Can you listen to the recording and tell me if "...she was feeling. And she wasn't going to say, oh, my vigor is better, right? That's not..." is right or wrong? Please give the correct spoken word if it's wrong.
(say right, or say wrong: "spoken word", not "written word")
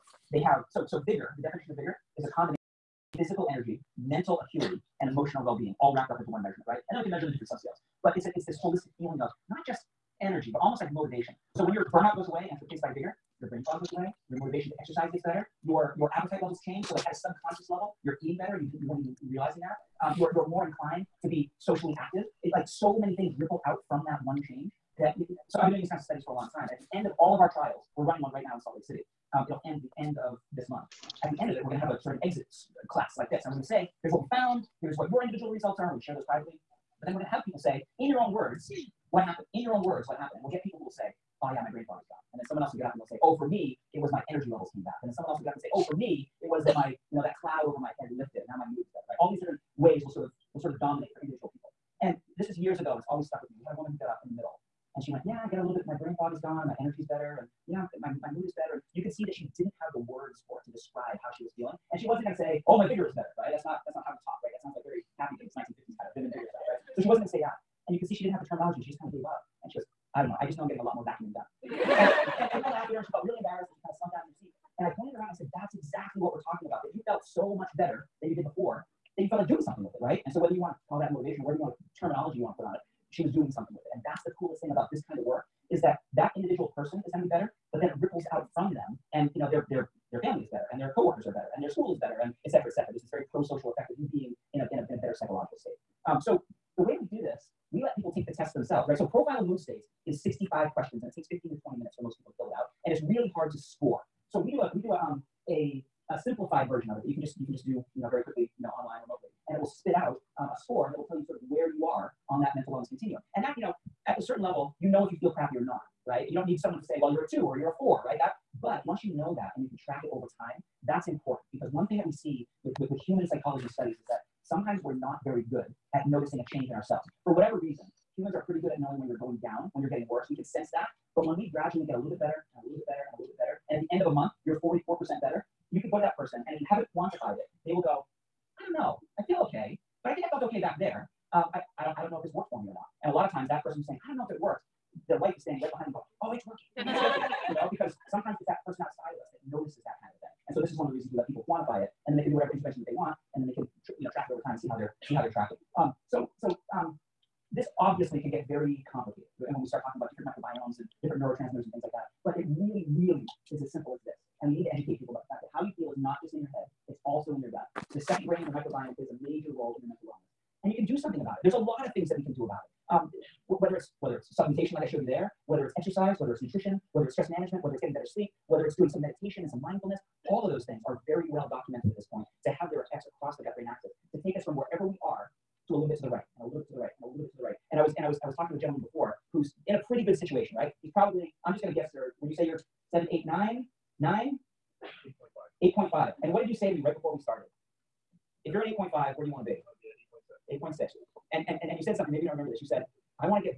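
right.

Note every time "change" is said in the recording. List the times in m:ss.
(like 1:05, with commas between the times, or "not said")
0:16, 0:24, 2:06.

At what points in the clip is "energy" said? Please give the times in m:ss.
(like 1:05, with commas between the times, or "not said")
0:03, 0:10, 0:44, 0:56.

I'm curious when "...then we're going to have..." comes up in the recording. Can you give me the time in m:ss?
0:37.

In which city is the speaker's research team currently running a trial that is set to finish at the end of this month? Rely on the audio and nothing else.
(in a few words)
Salt Lake City.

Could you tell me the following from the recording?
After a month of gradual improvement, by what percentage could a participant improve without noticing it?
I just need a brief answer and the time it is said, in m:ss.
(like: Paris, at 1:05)
44%, at 2:14.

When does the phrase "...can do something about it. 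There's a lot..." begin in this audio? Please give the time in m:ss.
2:50.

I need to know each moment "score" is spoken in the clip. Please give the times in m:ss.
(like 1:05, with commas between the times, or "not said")
1:43, 1:50.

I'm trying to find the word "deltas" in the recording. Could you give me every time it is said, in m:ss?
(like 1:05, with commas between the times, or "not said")
not said.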